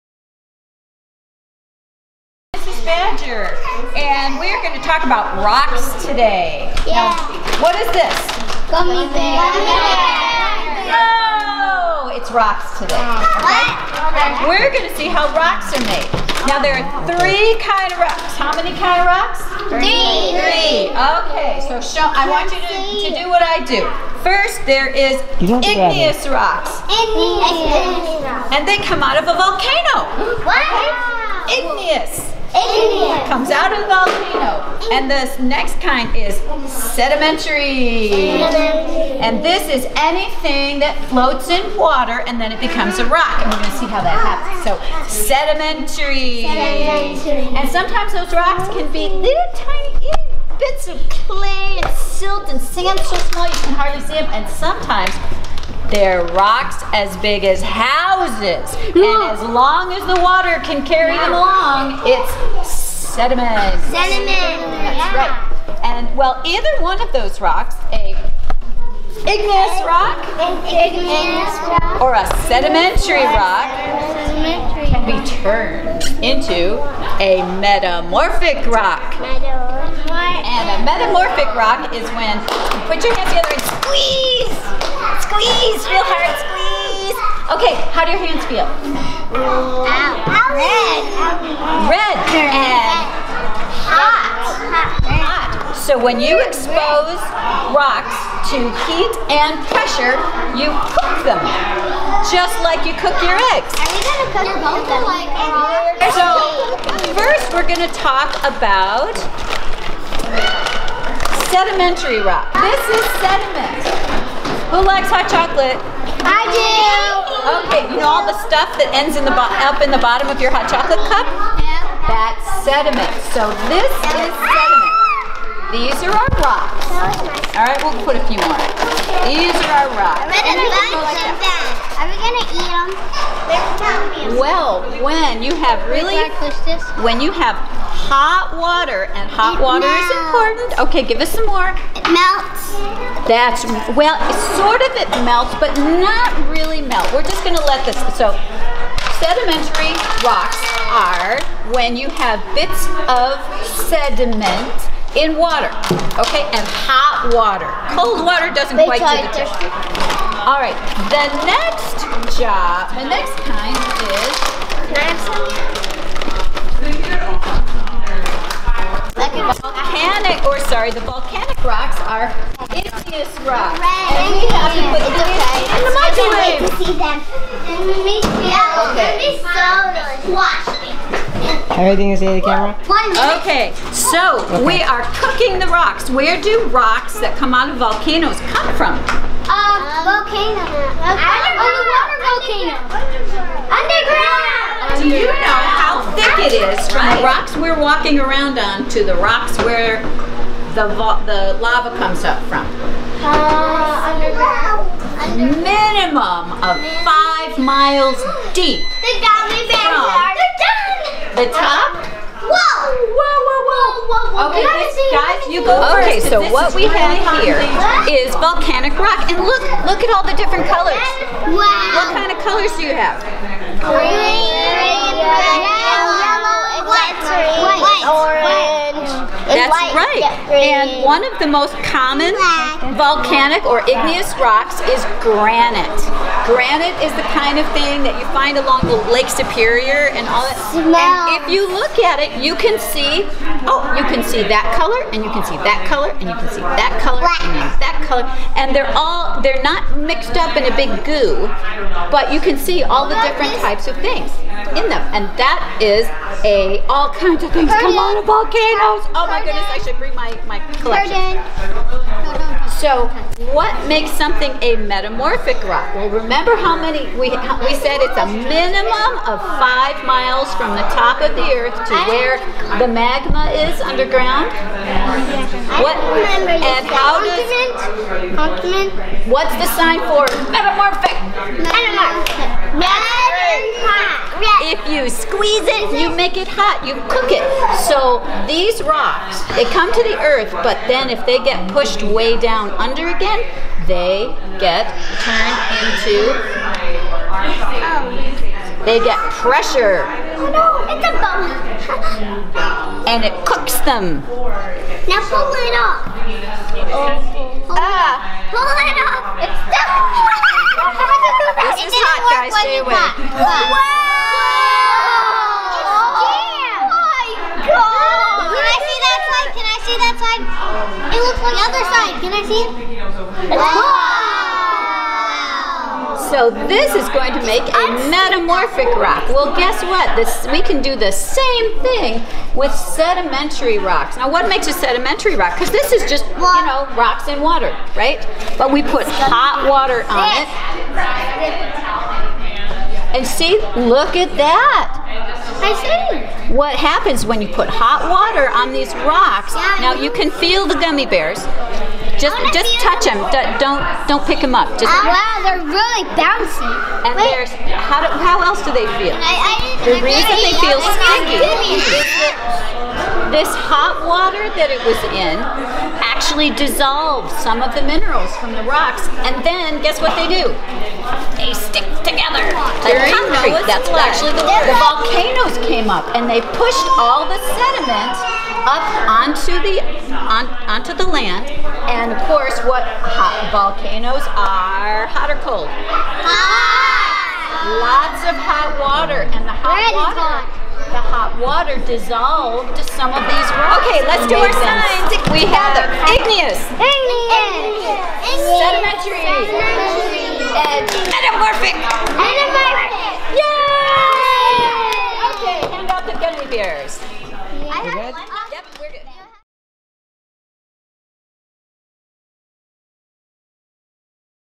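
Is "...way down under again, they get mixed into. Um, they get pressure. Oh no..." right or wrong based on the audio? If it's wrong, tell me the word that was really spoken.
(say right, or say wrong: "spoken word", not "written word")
wrong: "turned", not "mixed".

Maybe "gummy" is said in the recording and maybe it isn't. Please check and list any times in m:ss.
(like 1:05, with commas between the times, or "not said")
0:08, 5:50.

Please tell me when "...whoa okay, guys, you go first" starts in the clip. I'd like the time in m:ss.
3:34.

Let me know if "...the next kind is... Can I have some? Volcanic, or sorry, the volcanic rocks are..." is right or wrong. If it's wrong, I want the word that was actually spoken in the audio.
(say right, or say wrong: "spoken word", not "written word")
right.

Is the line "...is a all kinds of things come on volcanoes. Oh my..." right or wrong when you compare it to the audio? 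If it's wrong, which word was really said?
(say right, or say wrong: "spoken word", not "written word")
right.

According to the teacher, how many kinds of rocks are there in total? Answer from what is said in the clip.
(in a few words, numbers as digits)
3.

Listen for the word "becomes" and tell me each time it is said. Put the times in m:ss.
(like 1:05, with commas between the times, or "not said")
0:42.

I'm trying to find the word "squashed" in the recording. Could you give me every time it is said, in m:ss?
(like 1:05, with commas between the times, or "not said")
3:00.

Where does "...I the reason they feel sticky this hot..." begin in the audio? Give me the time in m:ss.
5:59.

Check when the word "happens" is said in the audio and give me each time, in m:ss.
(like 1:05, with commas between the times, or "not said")
0:44, 5:46.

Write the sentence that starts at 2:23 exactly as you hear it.
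That's, well, sort of it melts, but not really melt.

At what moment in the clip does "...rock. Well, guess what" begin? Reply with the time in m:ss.
5:28.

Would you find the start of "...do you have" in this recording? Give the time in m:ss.
3:42.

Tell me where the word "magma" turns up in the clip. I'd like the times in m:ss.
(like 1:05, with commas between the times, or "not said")
4:32.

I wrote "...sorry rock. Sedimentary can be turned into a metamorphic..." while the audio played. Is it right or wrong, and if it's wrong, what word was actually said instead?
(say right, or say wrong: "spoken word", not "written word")
wrong: "sedimentary", not "sorry".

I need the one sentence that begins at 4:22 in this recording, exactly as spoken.
So what makes something a metamorphic rock?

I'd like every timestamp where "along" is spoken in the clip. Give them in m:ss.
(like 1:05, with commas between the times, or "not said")
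1:01, 3:58.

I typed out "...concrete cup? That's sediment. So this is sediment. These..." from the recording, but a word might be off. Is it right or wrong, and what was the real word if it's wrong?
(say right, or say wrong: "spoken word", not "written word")
wrong: "chocolate", not "concrete".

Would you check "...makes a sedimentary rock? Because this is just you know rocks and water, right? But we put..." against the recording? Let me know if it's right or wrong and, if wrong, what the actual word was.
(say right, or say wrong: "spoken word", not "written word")
right.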